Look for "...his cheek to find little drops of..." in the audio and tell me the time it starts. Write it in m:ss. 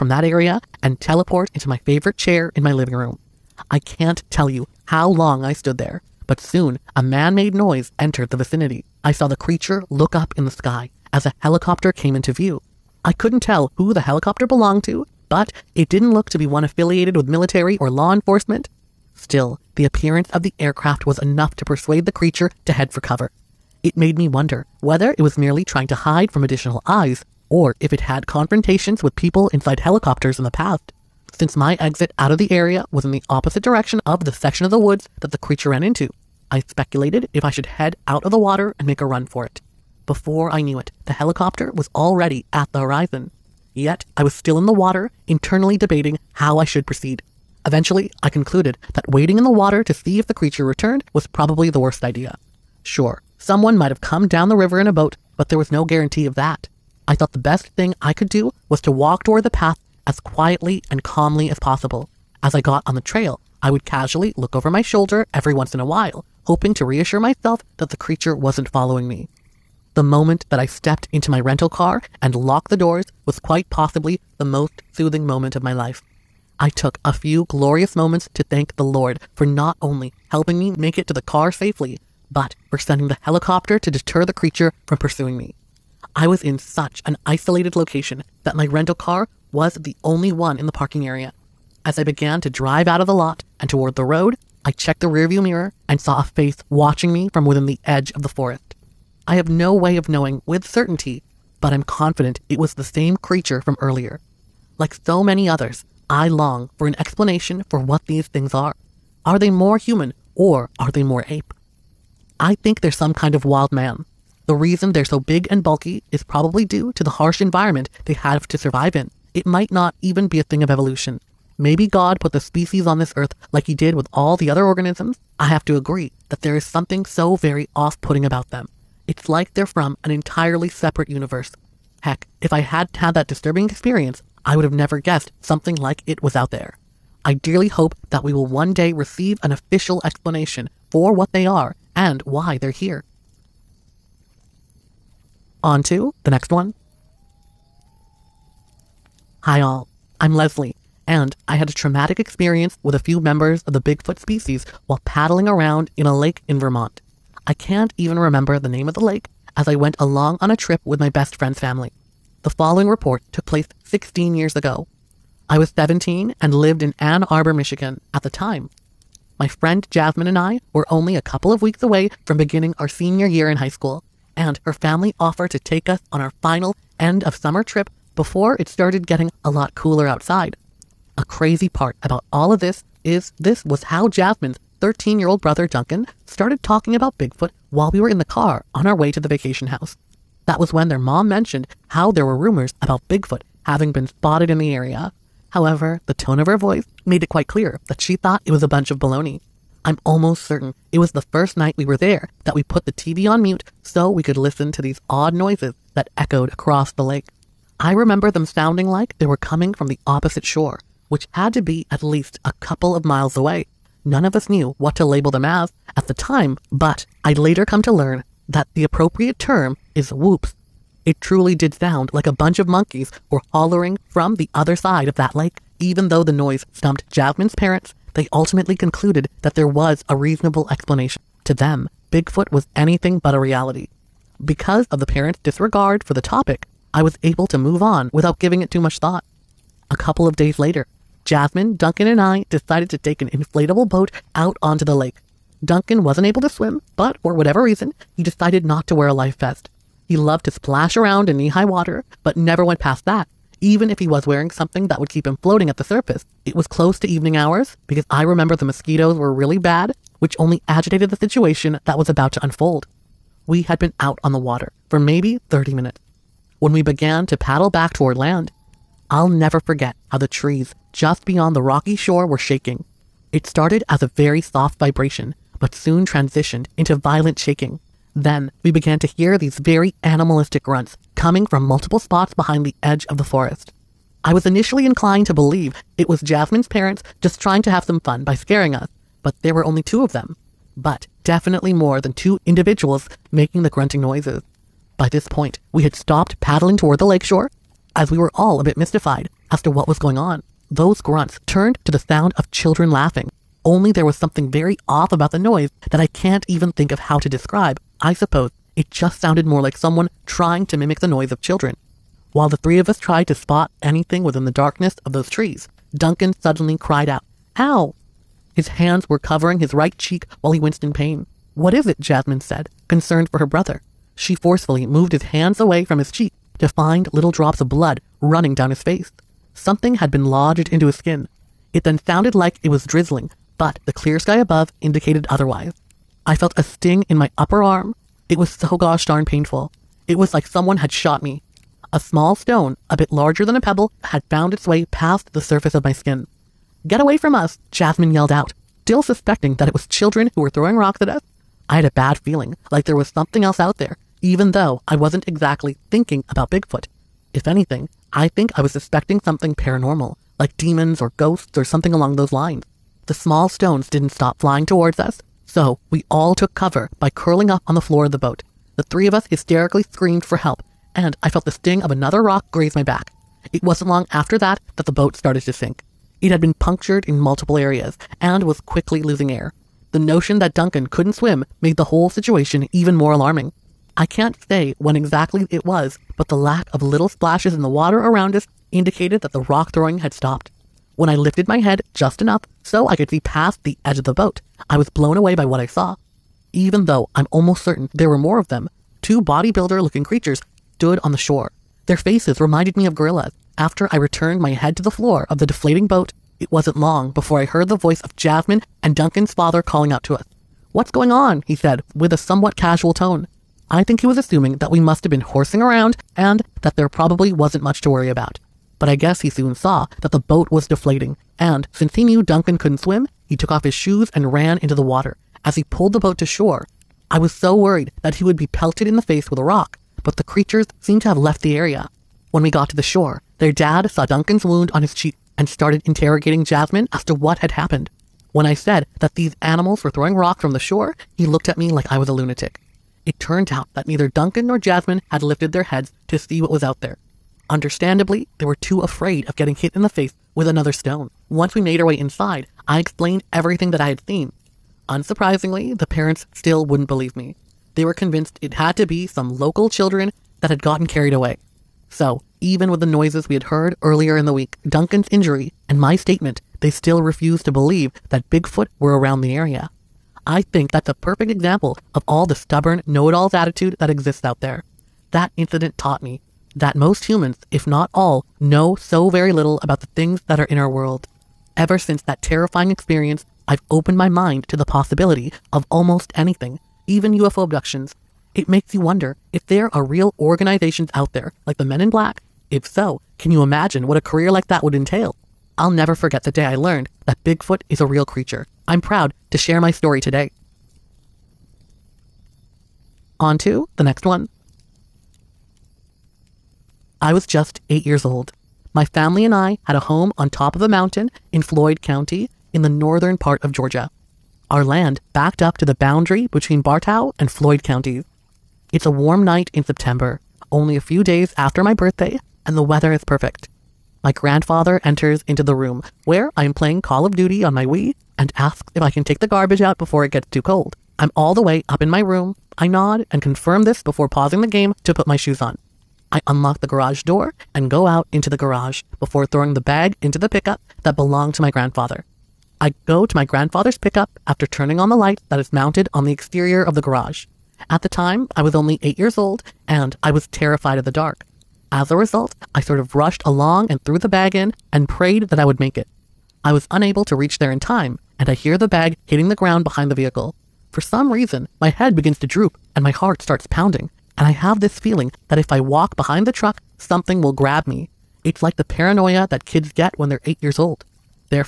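5:25.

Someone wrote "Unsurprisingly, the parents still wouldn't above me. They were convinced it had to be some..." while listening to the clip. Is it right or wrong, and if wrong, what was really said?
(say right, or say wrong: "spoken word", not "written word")
wrong: "believe", not "above".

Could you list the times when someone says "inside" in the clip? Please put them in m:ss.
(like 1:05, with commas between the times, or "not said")
0:29, 7:31.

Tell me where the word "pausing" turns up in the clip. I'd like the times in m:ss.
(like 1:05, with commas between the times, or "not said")
8:54.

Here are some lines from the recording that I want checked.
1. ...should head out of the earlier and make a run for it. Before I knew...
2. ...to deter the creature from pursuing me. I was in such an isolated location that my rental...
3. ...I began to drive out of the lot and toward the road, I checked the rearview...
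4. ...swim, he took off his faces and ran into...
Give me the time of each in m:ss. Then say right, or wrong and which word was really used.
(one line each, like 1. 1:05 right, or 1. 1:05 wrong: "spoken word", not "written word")
1. 0:37 wrong: "water", not "earlier"
2. 1:23 right
3. 1:31 right
4. 7:02 wrong: "shoes", not "faces".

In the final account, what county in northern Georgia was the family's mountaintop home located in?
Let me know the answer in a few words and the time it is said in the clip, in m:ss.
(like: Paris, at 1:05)
Floyd County, at 8:31.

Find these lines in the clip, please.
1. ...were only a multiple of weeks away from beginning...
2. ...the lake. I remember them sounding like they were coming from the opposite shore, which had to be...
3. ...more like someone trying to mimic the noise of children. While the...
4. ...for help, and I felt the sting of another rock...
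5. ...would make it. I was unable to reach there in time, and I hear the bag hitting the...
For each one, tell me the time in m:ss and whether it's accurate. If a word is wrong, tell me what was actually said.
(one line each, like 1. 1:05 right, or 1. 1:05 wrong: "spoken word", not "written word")
1. 2:50 wrong: "couple", not "multiple"
2. 3:26 right
3. 5:09 right
4. 6:10 right
5. 9:15 right.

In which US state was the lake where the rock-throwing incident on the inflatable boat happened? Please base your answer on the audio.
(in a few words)
Vermont.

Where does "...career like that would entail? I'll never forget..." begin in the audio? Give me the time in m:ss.
8:14.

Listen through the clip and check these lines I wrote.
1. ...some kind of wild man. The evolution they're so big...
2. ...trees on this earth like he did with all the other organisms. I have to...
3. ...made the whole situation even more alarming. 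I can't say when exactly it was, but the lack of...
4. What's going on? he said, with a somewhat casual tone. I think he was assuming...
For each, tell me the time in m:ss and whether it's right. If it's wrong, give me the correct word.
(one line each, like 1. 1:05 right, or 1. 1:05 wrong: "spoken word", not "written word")
1. 1:52 wrong: "reason", not "evolution"
2. 2:02 wrong: "species", not "trees"
3. 6:21 right
4. 6:50 right.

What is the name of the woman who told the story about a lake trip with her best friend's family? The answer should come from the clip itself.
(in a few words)
Leslie.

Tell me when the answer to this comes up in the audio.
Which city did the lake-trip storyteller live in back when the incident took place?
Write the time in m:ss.
2:46.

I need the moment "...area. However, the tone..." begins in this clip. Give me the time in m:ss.
3:14.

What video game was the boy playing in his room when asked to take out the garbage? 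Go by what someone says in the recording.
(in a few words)
Call of Duty.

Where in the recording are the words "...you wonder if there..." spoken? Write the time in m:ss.
8:08.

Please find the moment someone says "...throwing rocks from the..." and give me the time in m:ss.
7:19.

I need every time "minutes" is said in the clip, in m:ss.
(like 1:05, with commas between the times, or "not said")
4:25.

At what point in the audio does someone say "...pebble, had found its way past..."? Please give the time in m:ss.
5:43.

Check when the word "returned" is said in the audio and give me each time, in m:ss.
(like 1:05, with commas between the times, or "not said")
0:50, 6:43.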